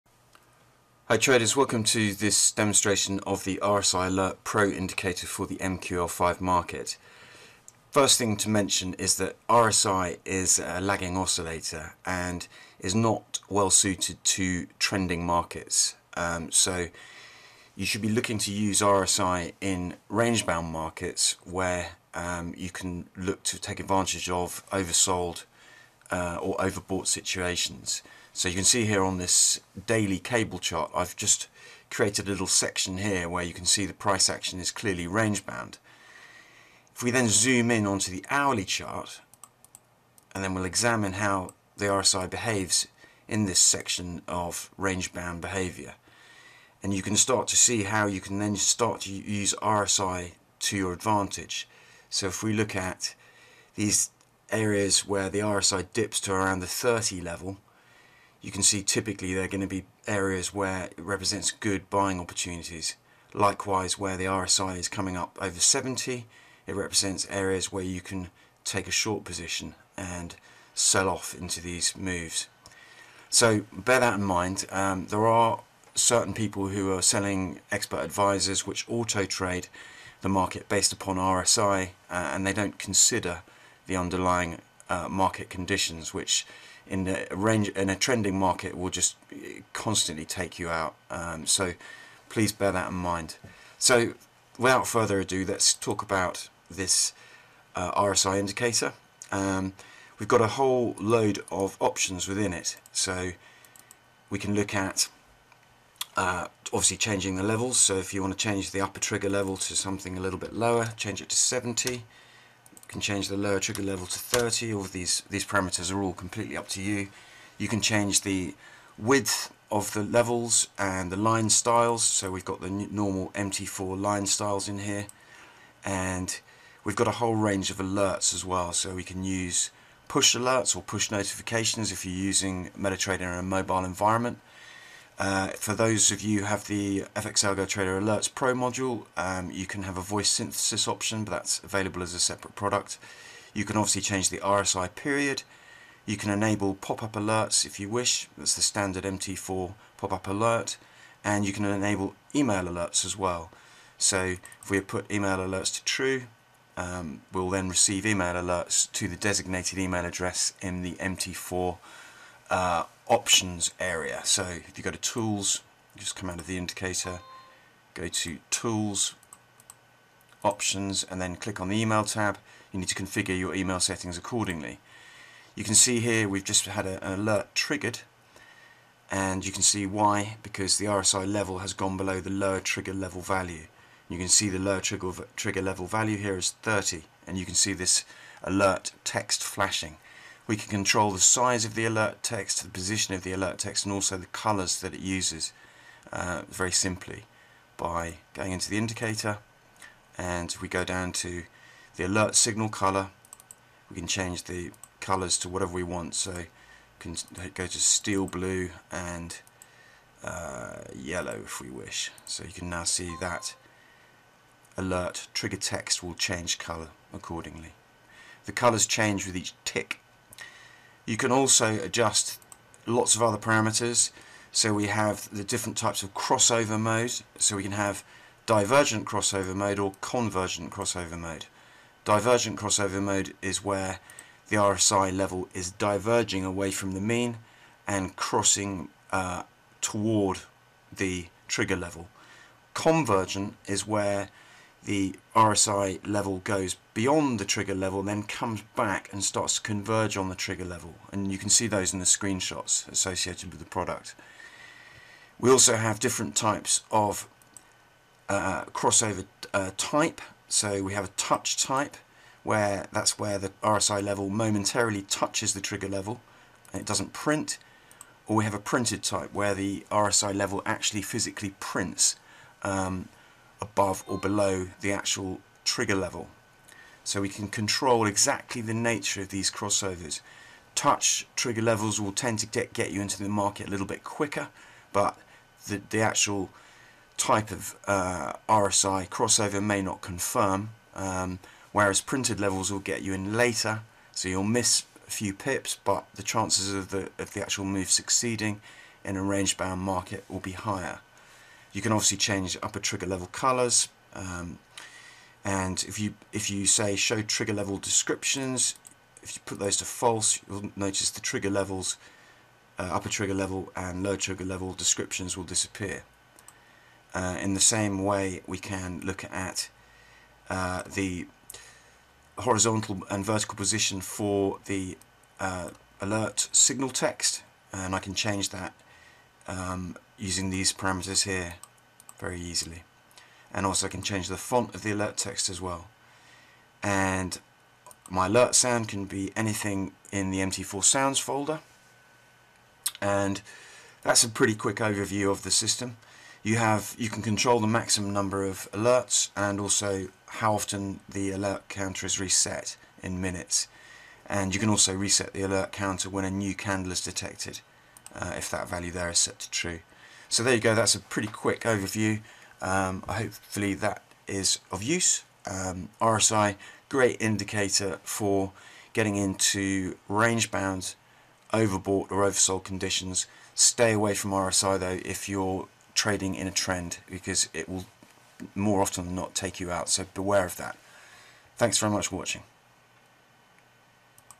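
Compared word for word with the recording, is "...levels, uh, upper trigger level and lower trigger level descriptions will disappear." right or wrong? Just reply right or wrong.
right.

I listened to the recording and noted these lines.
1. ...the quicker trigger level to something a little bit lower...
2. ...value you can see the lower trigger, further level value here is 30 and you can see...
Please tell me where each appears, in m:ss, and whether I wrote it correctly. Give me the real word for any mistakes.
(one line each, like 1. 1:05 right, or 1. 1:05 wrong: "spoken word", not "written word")
1. 1:48 wrong: "upper", not "quicker"
2. 3:03 wrong: "trigger", not "further".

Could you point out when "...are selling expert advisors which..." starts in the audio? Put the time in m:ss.
1:16.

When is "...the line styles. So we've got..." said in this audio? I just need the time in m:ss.
2:01.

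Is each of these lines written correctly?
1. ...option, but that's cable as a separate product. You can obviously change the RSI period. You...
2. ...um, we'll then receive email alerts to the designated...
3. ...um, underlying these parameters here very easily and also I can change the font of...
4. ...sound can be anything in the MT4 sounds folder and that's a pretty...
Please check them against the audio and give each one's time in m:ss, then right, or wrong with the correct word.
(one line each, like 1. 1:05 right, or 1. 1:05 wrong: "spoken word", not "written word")
1. 2:20 wrong: "available", not "cable"
2. 2:36 right
3. 5:29 wrong: "using", not "underlying"
4. 5:38 right.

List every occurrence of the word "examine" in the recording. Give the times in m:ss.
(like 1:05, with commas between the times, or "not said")
0:40.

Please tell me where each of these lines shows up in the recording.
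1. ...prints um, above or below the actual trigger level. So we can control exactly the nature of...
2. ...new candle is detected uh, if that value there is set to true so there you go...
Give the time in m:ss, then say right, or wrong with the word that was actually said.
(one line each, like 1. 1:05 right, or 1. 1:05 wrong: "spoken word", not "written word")
1. 4:31 right
2. 5:56 right.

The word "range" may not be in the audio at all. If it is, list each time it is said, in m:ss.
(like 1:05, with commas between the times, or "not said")
0:20, 0:35, 0:44, 1:27, 2:07, 4:59, 6:10.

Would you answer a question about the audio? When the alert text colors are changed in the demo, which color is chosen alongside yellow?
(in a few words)
Steel blue.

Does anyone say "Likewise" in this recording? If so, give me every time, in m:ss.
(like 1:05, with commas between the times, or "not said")
1:03.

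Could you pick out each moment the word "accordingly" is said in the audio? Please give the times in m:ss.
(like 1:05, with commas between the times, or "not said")
2:54, 3:37.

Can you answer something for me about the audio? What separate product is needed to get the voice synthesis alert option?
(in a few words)
FX Algo Trader Alerts Pro.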